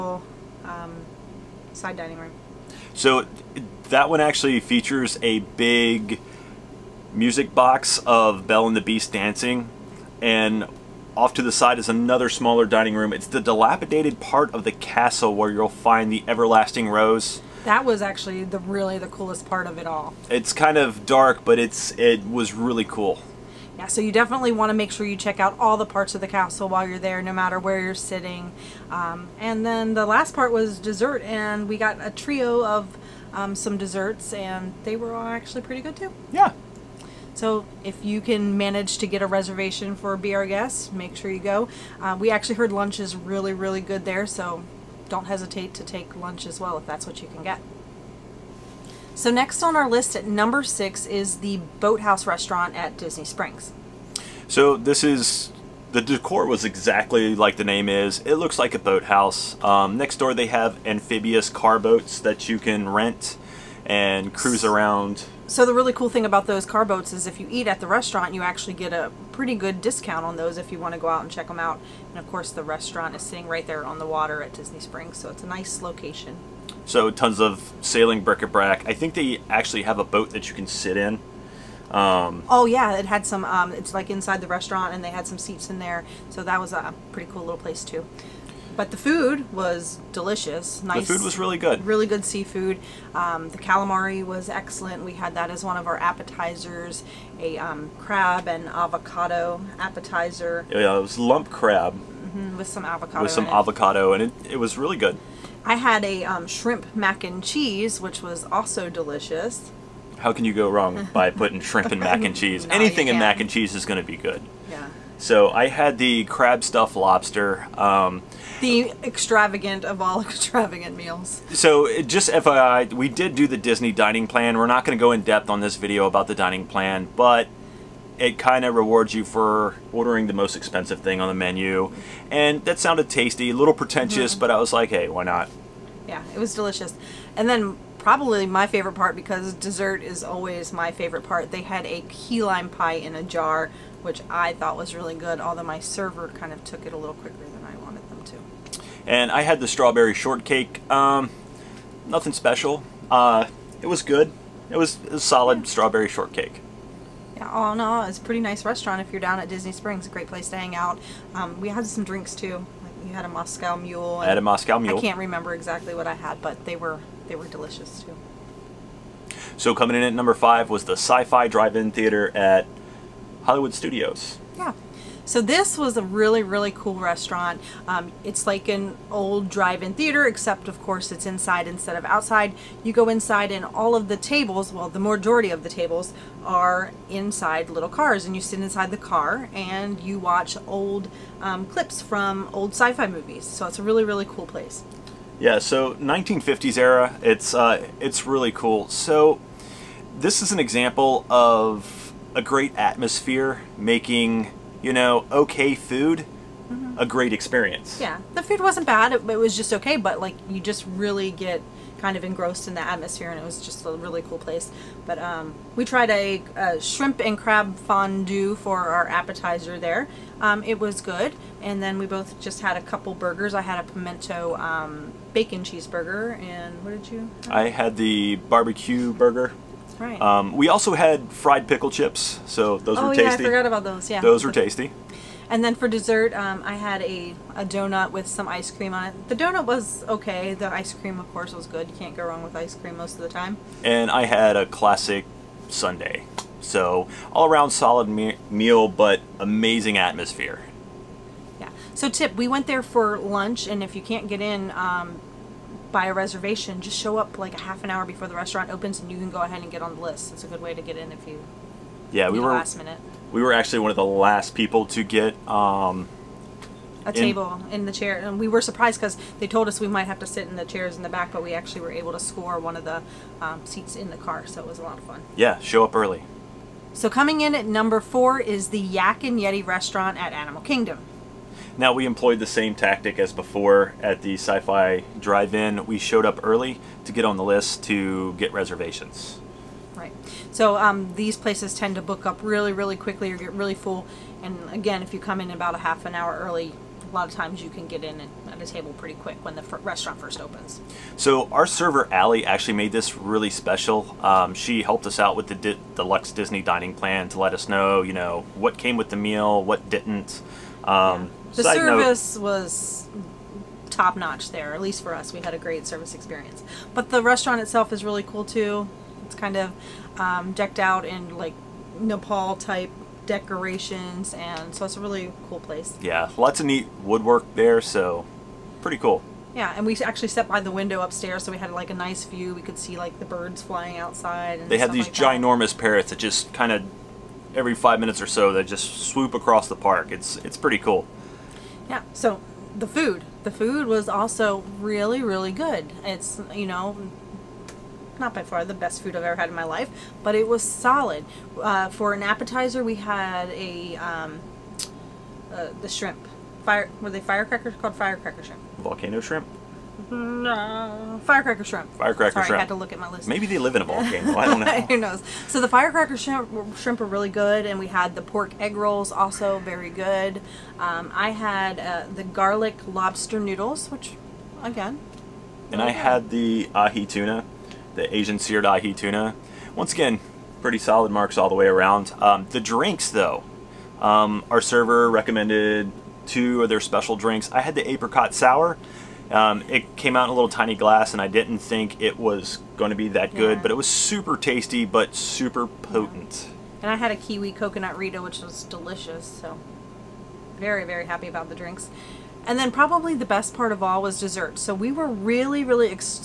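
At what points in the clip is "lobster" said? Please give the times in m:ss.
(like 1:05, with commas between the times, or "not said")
1:56, 6:12.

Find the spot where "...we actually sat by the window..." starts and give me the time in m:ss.
5:29.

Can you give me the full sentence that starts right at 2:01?
So just FYI, we did do the Disney dining plan.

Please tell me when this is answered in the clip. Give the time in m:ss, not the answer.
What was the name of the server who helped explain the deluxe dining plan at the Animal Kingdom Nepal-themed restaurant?
5:02.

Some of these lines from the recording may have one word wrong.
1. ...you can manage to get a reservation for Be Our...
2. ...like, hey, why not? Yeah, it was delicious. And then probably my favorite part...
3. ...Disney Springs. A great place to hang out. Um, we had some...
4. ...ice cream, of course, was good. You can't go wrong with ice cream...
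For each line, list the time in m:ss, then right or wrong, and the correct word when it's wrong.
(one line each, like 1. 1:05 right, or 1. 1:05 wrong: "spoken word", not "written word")
1. 0:38 right
2. 2:14 right
3. 2:39 right
4. 4:00 right.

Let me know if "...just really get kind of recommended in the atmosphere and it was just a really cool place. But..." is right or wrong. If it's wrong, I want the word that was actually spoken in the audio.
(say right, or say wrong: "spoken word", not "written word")
wrong: "engrossed", not "recommended".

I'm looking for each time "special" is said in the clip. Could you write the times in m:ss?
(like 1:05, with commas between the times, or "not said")
2:32, 5:03, 6:26.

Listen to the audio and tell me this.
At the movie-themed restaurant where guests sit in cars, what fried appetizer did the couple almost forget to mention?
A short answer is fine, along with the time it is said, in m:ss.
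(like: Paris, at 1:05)
Fried pickle chips, at 3:51.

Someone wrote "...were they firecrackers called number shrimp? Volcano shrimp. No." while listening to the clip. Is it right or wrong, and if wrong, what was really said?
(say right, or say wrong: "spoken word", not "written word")
wrong: "firecracker", not "number".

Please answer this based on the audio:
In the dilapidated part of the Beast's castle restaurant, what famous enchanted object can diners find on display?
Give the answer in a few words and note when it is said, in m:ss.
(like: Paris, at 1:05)
Everlasting rose, at 0:16.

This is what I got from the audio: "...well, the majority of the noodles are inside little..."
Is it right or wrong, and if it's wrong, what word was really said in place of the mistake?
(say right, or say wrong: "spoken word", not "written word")
wrong: "tables", not "noodles".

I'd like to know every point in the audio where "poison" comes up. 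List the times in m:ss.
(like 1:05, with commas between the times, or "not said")
not said.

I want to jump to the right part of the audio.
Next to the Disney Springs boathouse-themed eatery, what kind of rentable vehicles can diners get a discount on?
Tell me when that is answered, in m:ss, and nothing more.
1:00.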